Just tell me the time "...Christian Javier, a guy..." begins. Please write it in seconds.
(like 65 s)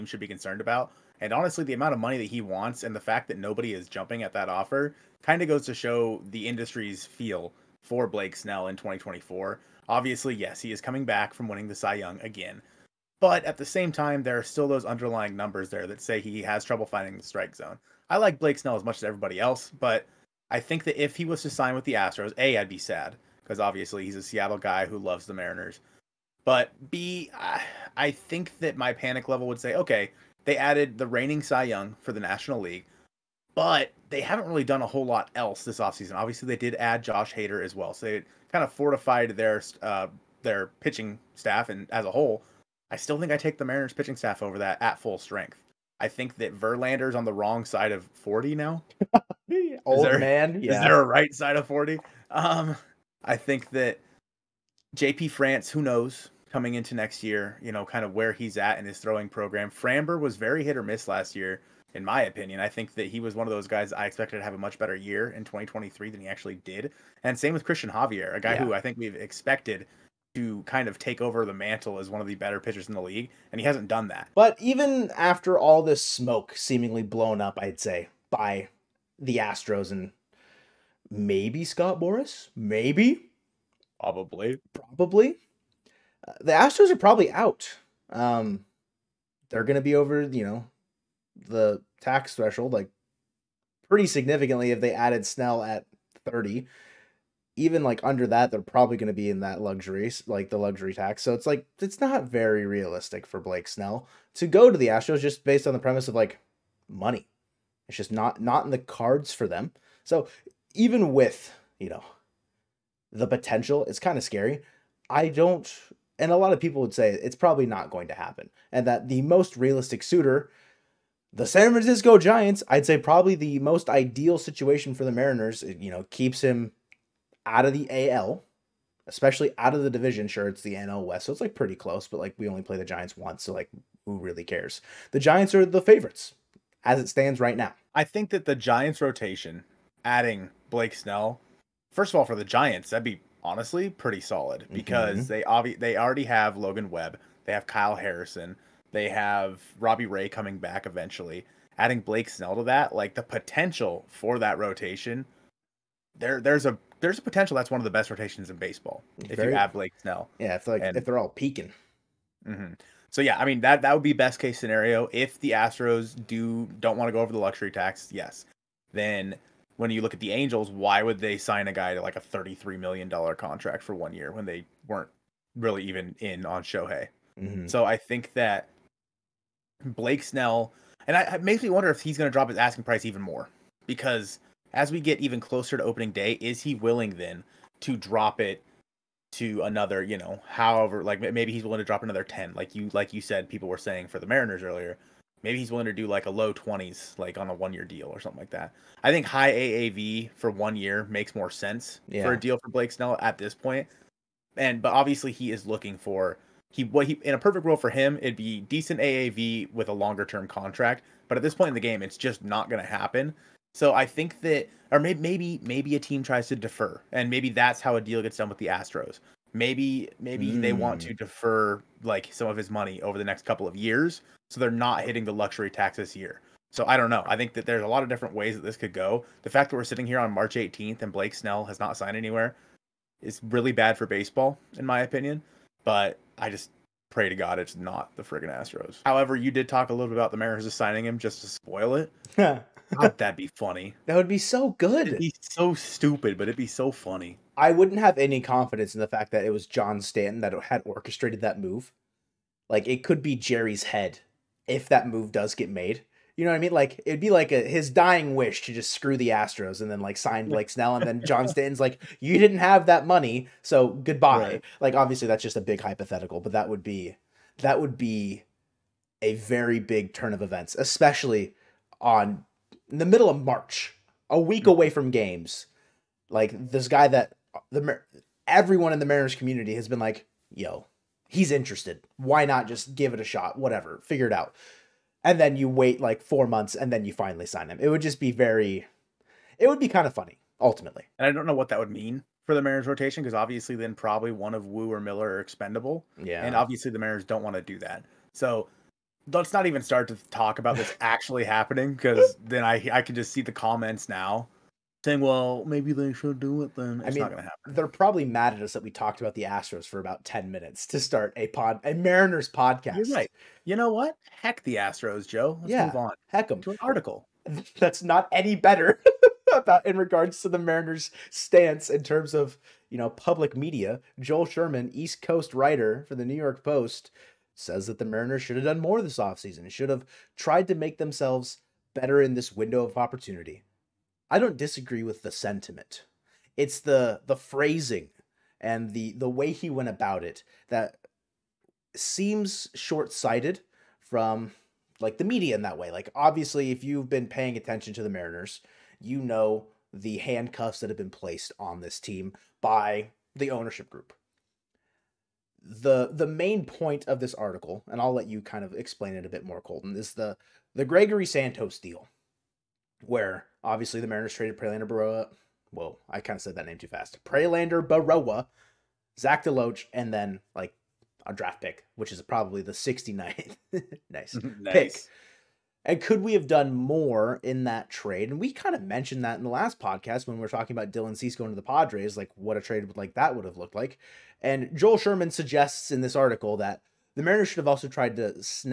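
67 s.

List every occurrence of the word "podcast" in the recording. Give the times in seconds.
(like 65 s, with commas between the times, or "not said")
312 s, 379 s.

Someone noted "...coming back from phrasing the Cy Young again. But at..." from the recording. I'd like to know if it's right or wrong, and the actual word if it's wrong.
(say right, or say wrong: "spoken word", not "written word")
wrong: "winning", not "phrasing".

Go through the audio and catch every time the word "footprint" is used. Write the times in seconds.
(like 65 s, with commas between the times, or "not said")
not said.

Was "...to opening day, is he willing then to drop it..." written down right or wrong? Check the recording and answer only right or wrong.
right.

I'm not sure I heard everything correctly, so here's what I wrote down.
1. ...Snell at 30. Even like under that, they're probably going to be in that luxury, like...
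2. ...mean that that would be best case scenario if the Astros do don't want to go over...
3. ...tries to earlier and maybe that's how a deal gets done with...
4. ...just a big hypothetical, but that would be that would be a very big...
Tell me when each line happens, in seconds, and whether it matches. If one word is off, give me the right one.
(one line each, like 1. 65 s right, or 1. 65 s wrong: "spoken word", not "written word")
1. 95 s right
2. 163 s right
3. 216 s wrong: "defer", not "earlier"
4. 265 s right.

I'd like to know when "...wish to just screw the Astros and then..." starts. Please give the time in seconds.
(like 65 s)
258 s.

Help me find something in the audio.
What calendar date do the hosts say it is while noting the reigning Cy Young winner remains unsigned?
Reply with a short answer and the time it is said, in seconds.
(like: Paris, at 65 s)
March 18th, at 230 s.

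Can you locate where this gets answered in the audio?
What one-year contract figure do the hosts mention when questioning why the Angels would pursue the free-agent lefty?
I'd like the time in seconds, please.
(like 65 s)
172 s.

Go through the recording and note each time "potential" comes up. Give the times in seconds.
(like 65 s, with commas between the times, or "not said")
113 s, 153 s, 157 s.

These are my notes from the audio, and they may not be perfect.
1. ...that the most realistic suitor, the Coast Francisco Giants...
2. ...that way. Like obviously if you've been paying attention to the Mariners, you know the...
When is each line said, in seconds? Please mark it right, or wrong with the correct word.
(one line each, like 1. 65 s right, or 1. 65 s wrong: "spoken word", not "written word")
1. 118 s wrong: "San", not "Coast"
2. 345 s right.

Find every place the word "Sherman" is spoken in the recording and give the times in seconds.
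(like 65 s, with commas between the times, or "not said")
324 s, 384 s.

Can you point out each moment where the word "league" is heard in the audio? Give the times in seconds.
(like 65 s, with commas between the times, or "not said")
32 s, 73 s.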